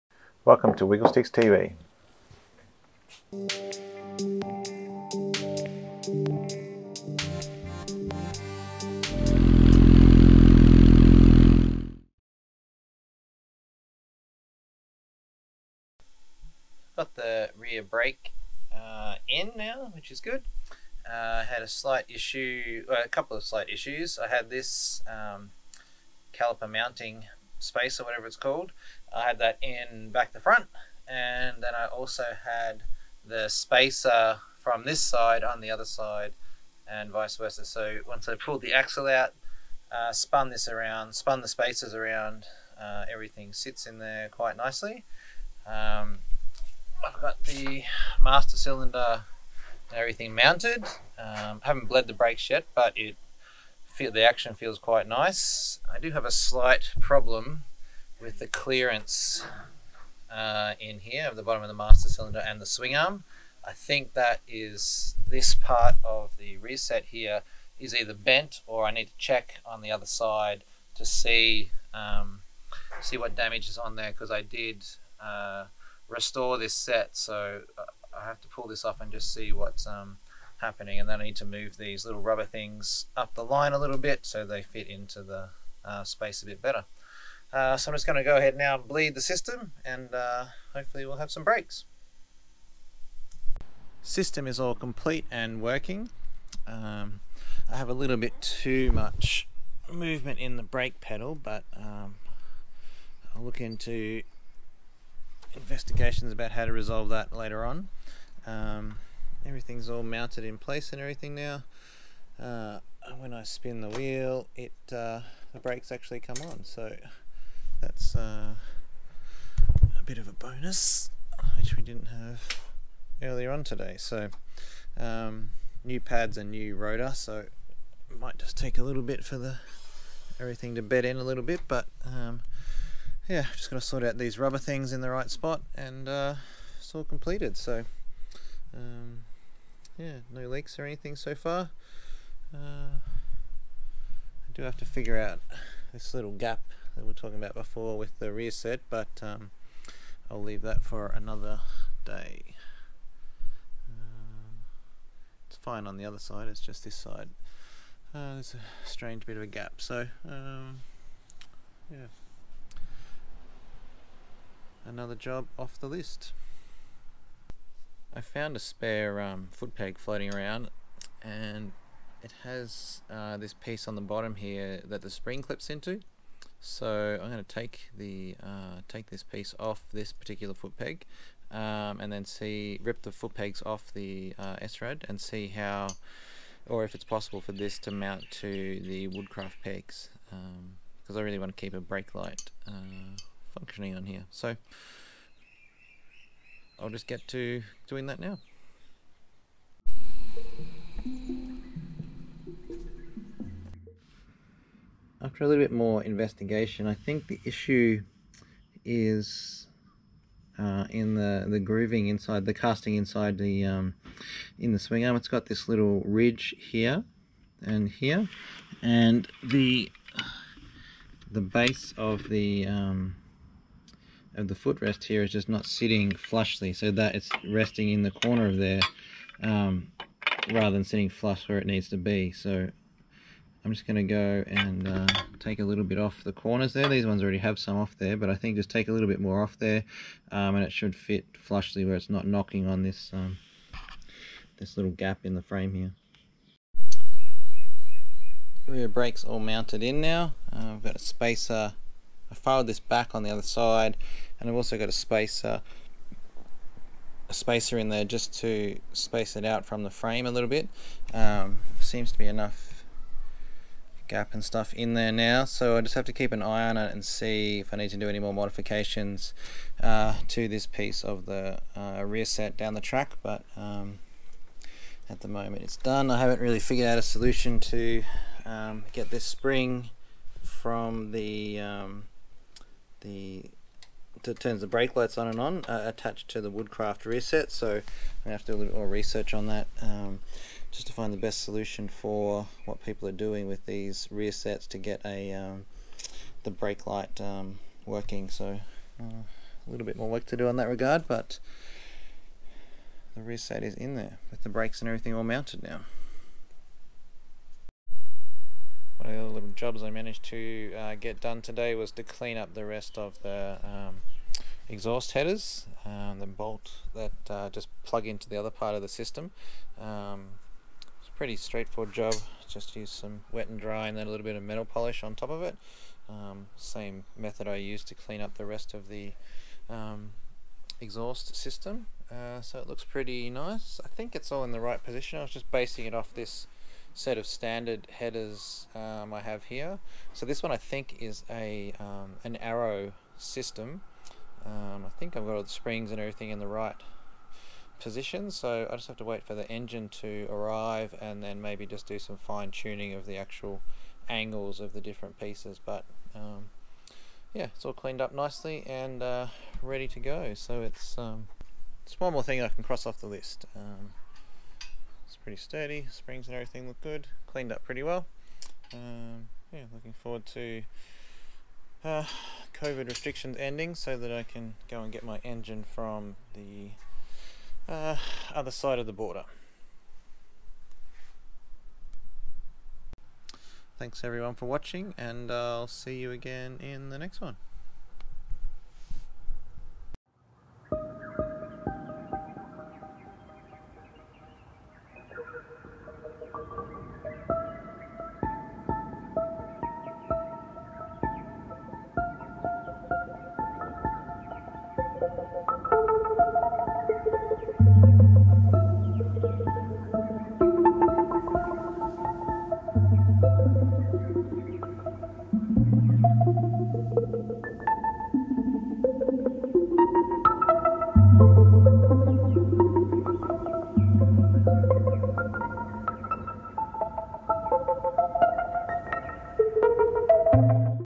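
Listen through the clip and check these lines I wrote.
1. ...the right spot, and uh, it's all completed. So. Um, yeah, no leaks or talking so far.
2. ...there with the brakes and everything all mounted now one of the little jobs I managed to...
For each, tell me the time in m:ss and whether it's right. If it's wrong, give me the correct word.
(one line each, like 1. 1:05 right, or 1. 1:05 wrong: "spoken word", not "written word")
1. 2:15 wrong: "anything", not "talking"
2. 5:03 right.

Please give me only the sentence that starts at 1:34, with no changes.
System is all complete and working.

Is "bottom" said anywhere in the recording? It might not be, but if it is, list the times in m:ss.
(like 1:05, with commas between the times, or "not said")
1:01, 2:54.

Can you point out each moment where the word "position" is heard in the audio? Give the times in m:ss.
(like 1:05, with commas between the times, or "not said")
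5:34, 5:47.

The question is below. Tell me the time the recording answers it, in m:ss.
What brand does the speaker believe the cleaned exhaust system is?
5:42.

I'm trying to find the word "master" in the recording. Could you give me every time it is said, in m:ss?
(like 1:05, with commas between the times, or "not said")
0:48, 1:01.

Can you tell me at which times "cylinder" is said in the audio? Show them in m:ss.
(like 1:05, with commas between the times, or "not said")
0:48, 1:02.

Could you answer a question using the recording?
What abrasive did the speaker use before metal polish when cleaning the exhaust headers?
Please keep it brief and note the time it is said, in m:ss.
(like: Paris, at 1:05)
Wet and dry, at 5:23.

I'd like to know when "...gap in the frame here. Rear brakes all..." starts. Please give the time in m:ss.
4:04.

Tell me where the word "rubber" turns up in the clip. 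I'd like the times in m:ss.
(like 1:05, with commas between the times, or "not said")
1:22, 2:14.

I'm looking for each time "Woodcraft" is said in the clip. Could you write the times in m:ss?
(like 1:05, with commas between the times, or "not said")
3:09, 4:46.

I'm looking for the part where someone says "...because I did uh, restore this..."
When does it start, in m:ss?
1:14.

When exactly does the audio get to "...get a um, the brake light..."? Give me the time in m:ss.
4:54.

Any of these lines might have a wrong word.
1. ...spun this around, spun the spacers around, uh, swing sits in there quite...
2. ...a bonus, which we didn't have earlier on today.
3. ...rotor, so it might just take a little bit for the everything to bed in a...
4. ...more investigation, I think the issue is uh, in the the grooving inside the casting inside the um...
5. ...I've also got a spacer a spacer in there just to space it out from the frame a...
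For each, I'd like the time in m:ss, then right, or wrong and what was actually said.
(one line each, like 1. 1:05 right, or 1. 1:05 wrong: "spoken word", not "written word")
1. 0:40 wrong: "everything", not "swing"
2. 2:00 right
3. 2:06 right
4. 3:25 right
5. 4:14 right.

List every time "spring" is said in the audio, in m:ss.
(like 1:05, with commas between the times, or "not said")
2:55, 4:39, 5:45, 6:05.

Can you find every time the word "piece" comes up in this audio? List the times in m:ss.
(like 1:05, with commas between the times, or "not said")
2:53, 2:59, 4:30, 5:55.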